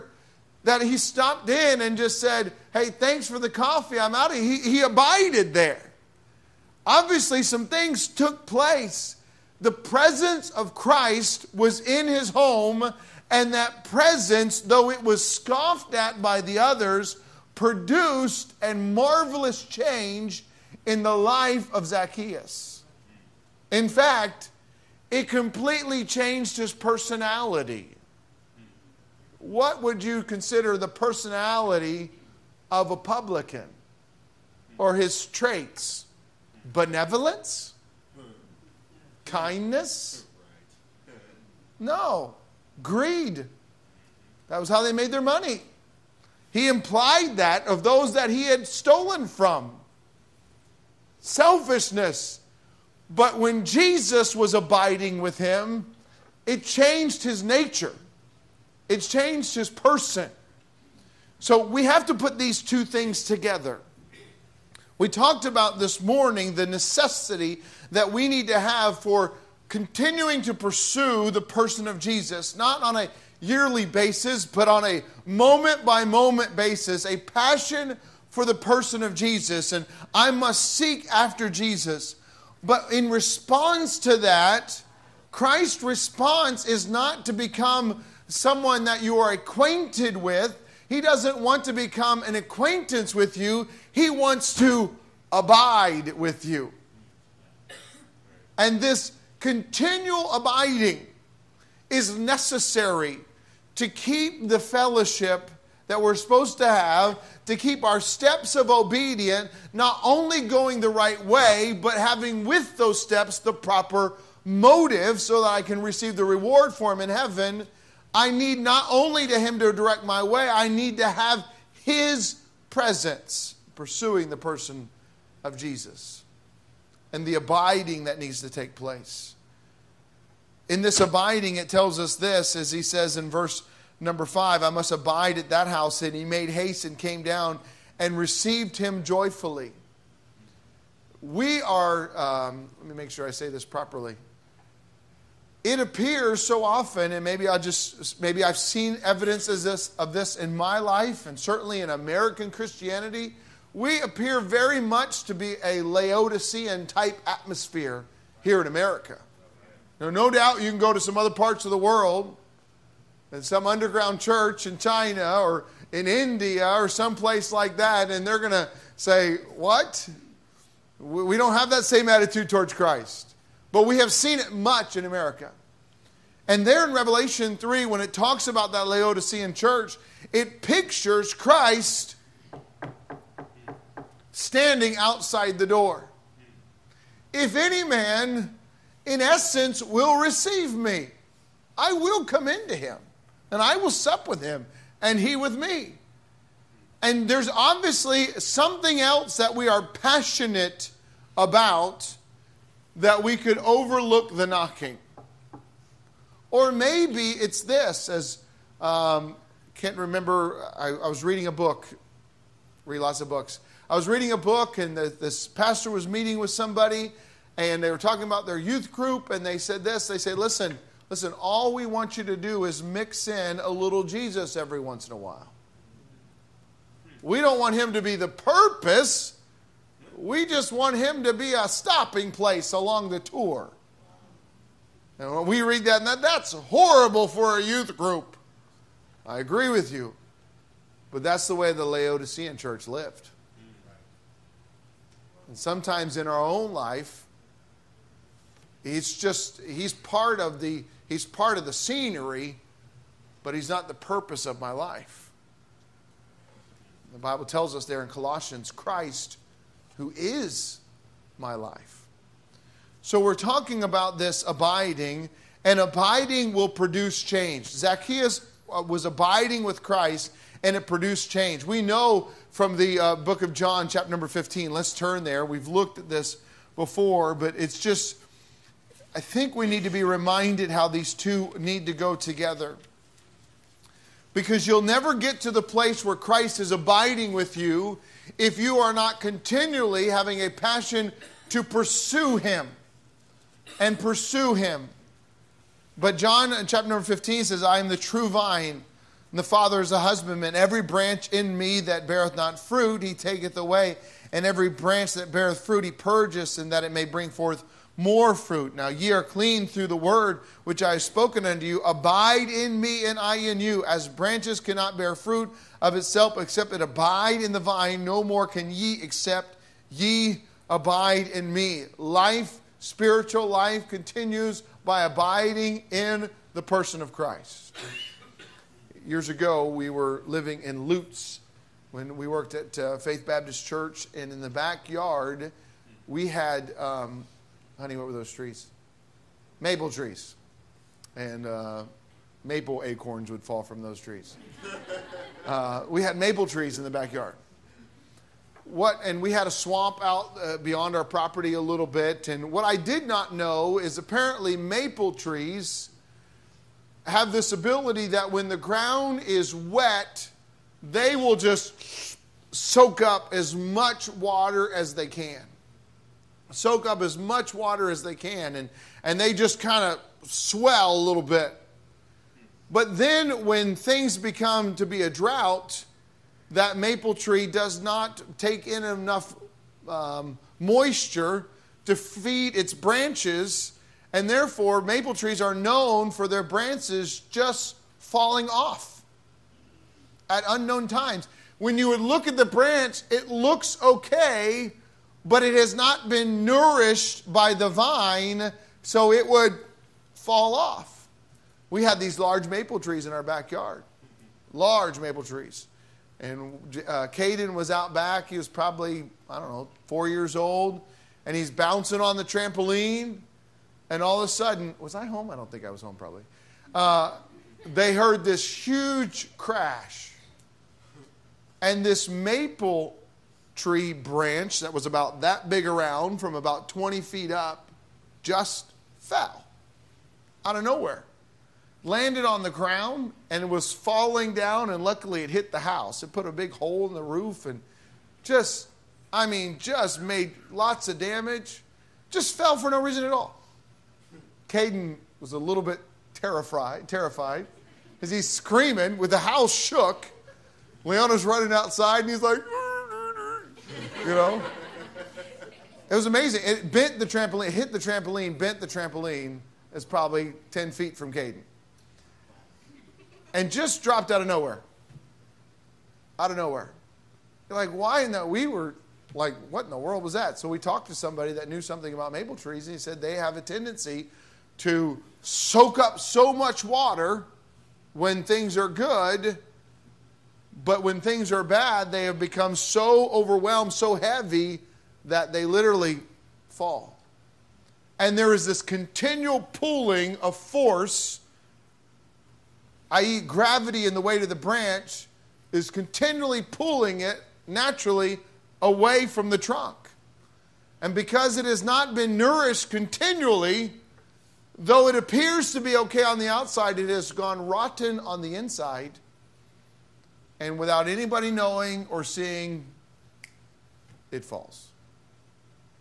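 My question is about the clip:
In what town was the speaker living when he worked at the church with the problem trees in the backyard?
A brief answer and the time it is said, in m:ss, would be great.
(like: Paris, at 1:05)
Lutz, at 5:30.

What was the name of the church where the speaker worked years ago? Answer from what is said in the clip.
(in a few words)
Faith Baptist Church.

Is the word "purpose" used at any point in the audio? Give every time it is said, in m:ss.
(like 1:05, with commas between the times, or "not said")
3:48, 4:13.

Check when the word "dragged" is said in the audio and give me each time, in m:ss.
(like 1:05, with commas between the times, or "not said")
not said.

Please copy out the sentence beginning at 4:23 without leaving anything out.
So we're talking about this abiding, and abiding will produce change.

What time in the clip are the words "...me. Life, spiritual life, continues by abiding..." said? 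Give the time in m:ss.
5:21.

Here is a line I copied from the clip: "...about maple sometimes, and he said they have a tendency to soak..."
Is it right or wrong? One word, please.
wrong.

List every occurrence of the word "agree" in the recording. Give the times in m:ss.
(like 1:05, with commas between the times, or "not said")
3:59.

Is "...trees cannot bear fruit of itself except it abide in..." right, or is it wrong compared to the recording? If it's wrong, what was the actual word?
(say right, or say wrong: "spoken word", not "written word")
wrong: "branches", not "trees".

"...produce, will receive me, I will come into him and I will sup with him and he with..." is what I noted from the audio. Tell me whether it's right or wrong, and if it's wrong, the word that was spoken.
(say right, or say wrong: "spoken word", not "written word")
wrong: "essence", not "produce".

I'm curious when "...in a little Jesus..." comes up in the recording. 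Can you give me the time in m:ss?
3:43.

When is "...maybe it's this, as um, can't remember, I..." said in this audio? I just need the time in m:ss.
3:26.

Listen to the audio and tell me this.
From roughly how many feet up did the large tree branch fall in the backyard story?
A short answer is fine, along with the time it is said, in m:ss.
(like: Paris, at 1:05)
20 feet, at 7:06.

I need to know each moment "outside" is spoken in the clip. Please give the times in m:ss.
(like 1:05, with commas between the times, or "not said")
3:04, 7:31, 8:26.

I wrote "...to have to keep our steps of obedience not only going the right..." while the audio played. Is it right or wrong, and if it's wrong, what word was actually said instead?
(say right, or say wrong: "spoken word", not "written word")
right.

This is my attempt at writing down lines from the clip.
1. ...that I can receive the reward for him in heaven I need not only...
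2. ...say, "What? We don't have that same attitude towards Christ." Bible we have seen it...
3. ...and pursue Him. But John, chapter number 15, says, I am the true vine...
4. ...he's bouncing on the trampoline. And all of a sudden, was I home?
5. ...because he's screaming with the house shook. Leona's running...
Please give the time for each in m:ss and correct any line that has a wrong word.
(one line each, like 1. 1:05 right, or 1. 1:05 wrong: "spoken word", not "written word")
1. 1:55 right
2. 2:48 wrong: "But", not "Bible"
3. 4:53 right
4. 6:51 right
5. 7:27 right.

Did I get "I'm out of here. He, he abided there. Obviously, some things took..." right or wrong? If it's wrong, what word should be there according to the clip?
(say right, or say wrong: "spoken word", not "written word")
right.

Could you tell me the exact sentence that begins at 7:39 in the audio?
It's probably 10 feet from Caden.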